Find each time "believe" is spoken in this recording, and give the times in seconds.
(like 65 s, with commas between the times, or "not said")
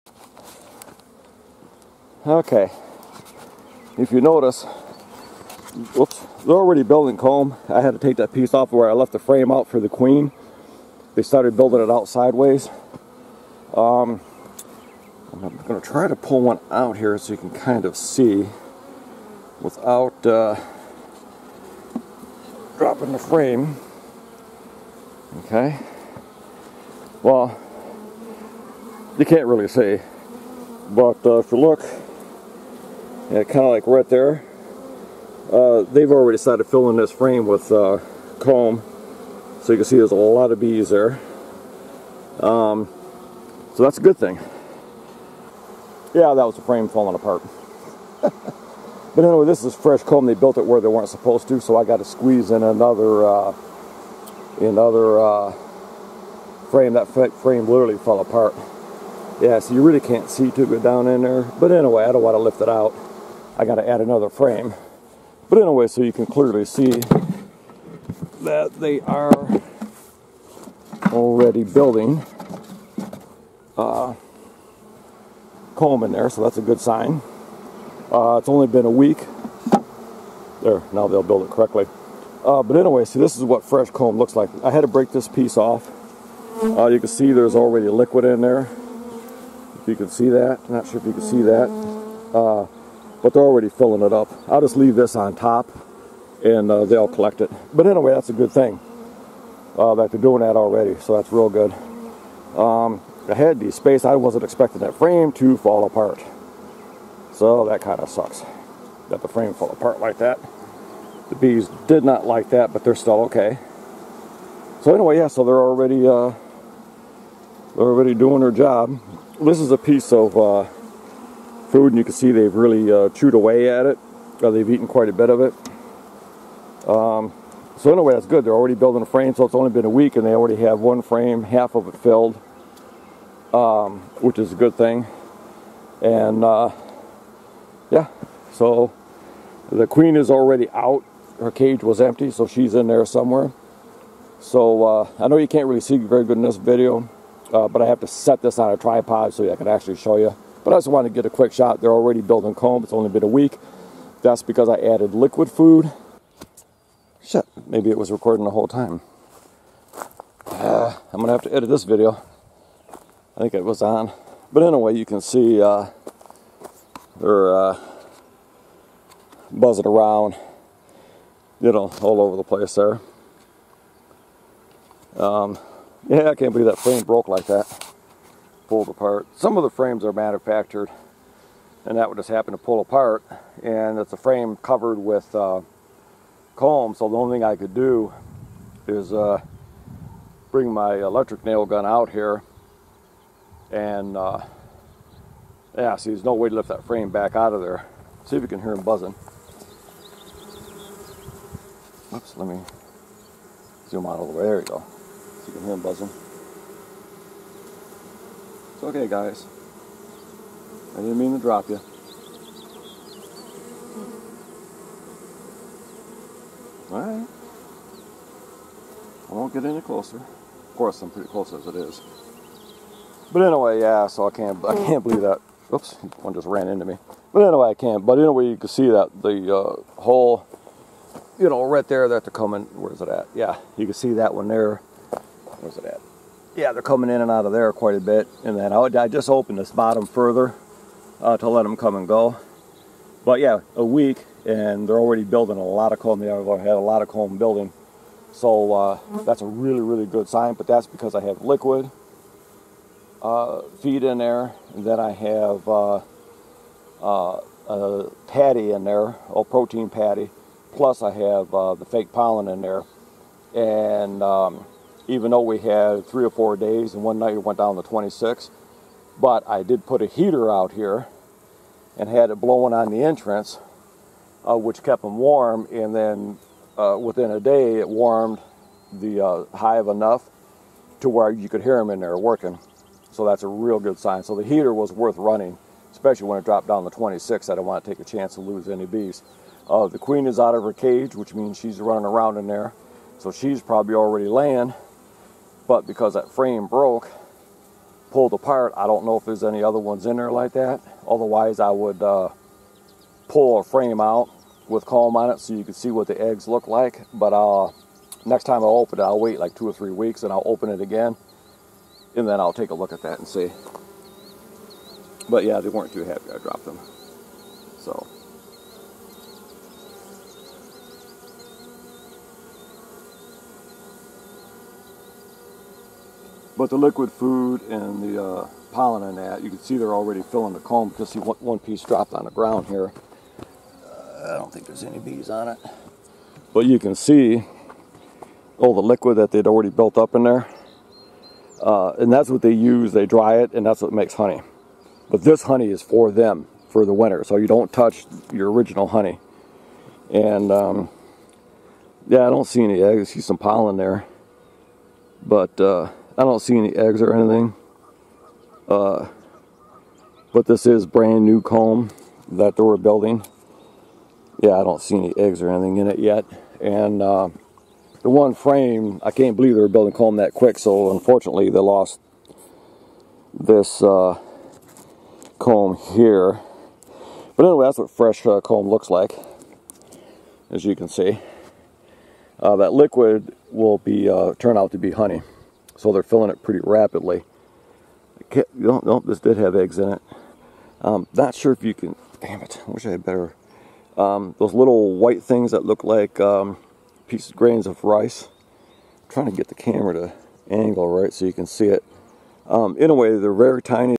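176 s, 225 s, 369 s.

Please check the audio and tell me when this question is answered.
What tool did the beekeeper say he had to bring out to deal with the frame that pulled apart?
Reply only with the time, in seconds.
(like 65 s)
190 s.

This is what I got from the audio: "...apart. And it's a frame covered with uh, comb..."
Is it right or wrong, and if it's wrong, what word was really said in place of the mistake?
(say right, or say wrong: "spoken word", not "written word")
right.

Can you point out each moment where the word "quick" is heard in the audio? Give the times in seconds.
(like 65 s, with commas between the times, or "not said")
151 s, 370 s.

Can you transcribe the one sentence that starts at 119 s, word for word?
This is a piece of uh, food and you can see they've really uh, chewed away at it.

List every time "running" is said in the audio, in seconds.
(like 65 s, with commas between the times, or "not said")
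285 s, 291 s.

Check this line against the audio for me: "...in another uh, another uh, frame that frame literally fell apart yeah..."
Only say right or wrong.
right.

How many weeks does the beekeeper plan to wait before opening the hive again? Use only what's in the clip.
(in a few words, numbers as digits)
2 or 3 weeks.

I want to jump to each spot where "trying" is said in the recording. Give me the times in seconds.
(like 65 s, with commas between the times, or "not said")
399 s.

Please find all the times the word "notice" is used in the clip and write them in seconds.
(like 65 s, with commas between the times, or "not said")
4 s.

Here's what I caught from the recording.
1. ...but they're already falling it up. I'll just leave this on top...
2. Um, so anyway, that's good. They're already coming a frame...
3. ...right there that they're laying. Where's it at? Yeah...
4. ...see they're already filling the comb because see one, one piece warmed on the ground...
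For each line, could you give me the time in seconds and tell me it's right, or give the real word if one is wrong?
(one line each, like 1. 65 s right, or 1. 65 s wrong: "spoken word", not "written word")
1. 93 s wrong: "filling", not "falling"
2. 126 s wrong: "building", not "coming"
3. 231 s wrong: "coming", not "laying"
4. 329 s wrong: "dropped", not "warmed".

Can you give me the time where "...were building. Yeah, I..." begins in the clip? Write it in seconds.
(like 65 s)
362 s.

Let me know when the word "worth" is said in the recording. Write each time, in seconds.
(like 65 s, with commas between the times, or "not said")
284 s.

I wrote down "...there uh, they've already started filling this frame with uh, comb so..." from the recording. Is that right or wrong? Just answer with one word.
right.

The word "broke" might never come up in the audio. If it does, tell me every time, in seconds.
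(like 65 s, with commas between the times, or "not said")
177 s, 296 s.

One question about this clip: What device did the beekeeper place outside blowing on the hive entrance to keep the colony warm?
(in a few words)
a heater.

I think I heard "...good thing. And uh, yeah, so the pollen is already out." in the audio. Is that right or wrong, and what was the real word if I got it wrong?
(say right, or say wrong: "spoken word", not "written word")
wrong: "queen", not "pollen".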